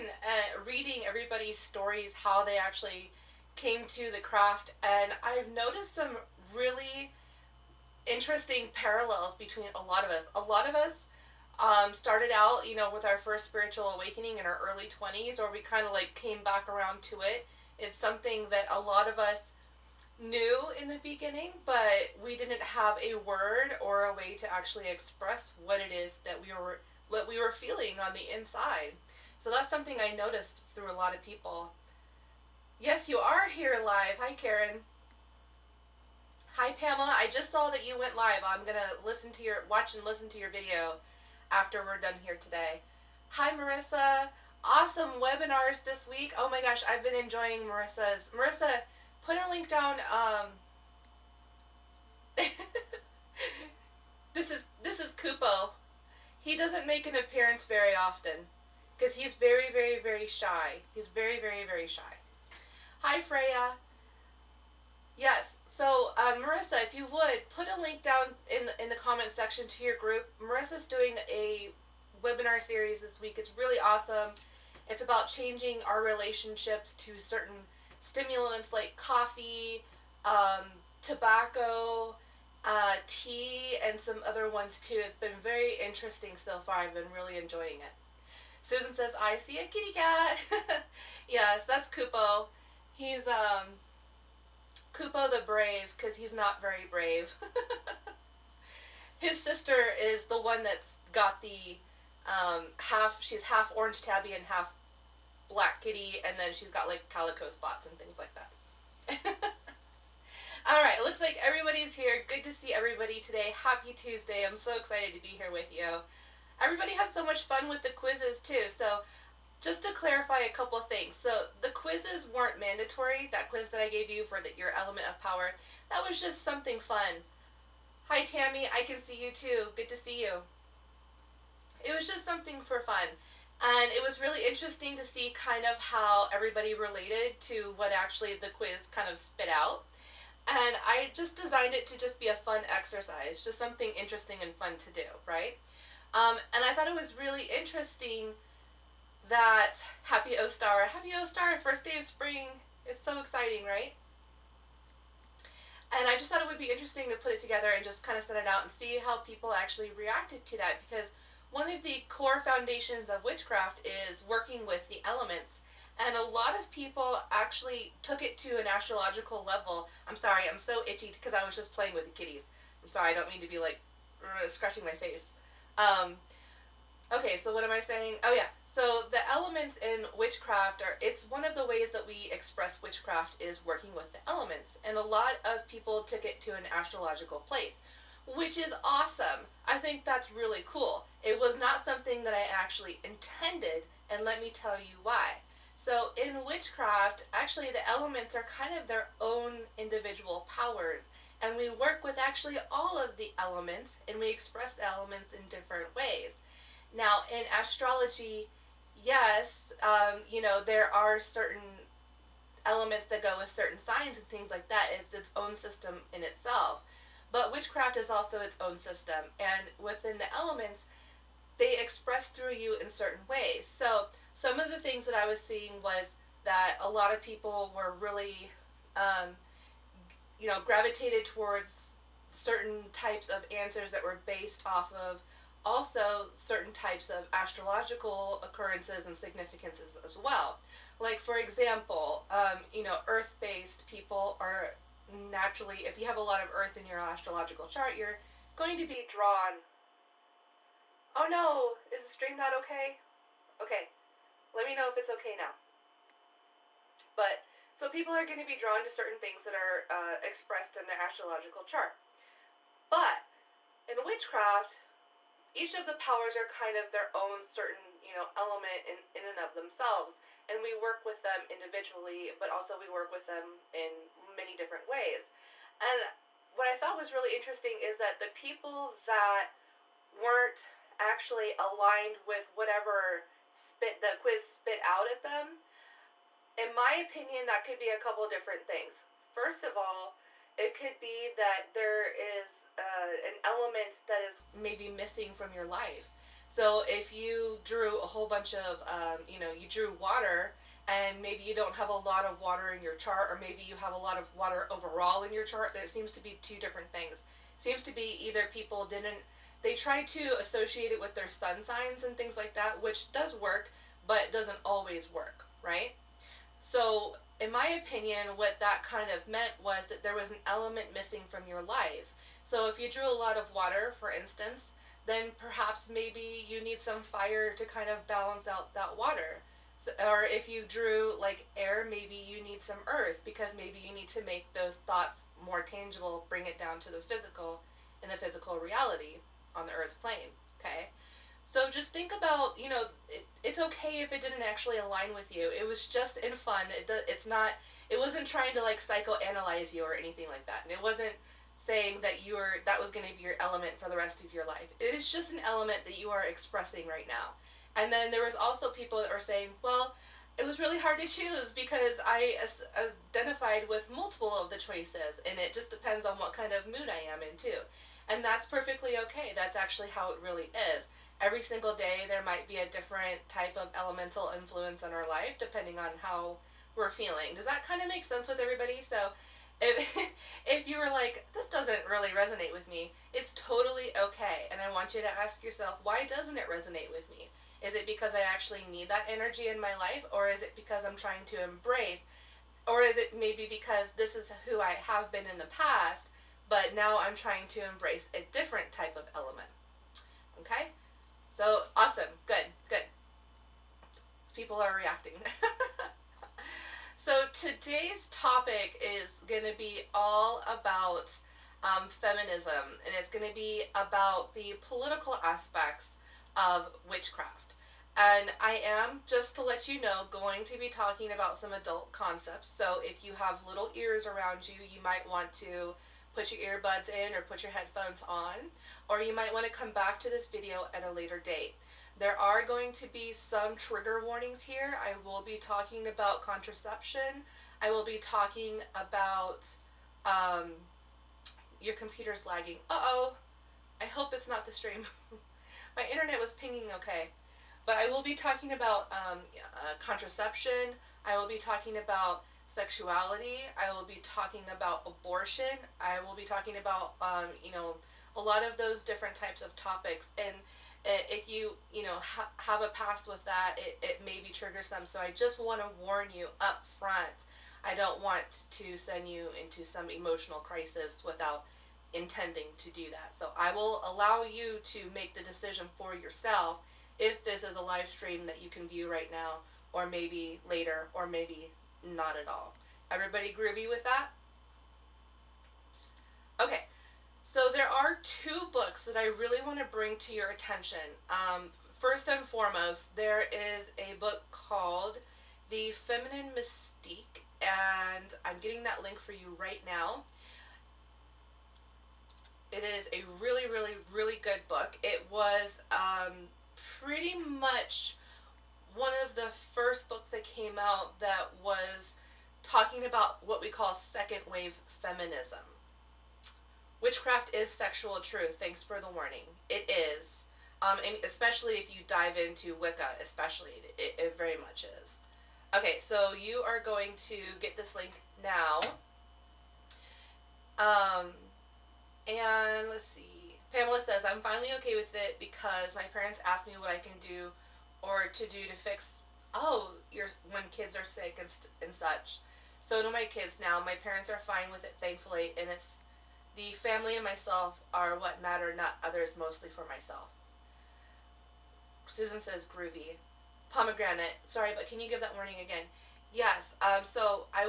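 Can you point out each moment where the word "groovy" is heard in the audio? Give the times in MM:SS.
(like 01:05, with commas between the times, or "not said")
08:03, 09:12.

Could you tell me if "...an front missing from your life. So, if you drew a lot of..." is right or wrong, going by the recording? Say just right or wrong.
wrong.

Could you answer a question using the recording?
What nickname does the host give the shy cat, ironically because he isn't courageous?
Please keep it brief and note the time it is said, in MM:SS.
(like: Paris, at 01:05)
Kupo the Brave, at 01:34.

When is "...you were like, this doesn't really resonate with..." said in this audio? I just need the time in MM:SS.
06:20.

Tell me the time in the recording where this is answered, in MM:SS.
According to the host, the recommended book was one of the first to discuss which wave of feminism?
08:33.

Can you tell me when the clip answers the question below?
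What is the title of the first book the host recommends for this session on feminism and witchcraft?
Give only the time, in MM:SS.
08:15.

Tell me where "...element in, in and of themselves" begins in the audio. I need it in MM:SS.
04:28.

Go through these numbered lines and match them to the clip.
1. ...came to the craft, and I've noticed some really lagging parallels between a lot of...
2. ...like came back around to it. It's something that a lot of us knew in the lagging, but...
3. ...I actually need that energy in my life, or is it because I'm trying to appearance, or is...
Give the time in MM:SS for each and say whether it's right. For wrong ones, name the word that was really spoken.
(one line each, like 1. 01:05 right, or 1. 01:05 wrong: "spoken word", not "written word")
1. 00:03 wrong: "interesting", not "lagging"
2. 00:15 wrong: "beginning", not "lagging"
3. 06:28 wrong: "embrace", not "appearance".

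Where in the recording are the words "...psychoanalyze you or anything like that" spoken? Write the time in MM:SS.
05:48.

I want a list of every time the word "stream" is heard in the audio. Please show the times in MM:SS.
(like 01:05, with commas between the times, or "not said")
04:12, 07:24, 07:57.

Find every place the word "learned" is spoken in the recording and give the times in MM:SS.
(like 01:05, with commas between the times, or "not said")
not said.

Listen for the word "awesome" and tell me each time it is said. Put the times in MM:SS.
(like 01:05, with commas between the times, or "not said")
00:44, 01:13, 03:08, 06:41.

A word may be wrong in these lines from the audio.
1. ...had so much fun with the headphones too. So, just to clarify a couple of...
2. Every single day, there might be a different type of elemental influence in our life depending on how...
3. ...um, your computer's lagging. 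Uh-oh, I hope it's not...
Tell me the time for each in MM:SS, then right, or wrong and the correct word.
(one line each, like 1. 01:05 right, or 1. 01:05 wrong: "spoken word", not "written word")
1. 01:56 wrong: "quizzes", not "headphones"
2. 06:11 right
3. 07:20 right.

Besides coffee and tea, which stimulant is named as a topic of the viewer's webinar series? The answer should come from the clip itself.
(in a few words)
tobacco.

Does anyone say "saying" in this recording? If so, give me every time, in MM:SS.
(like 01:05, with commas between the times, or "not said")
02:57, 05:51, 05:59.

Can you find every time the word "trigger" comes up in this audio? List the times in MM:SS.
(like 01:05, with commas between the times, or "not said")
07:13, 07:44.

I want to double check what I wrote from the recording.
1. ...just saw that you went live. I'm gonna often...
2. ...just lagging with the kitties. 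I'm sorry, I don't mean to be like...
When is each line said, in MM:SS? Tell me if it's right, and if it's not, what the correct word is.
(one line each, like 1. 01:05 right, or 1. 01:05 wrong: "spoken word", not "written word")
1. 00:37 wrong: "listen", not "often"
2. 02:51 wrong: "playing", not "lagging".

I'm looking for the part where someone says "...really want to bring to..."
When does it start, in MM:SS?
08:09.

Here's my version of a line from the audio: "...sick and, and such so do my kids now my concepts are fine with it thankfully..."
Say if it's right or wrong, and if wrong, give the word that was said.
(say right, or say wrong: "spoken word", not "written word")
wrong: "parents", not "concepts".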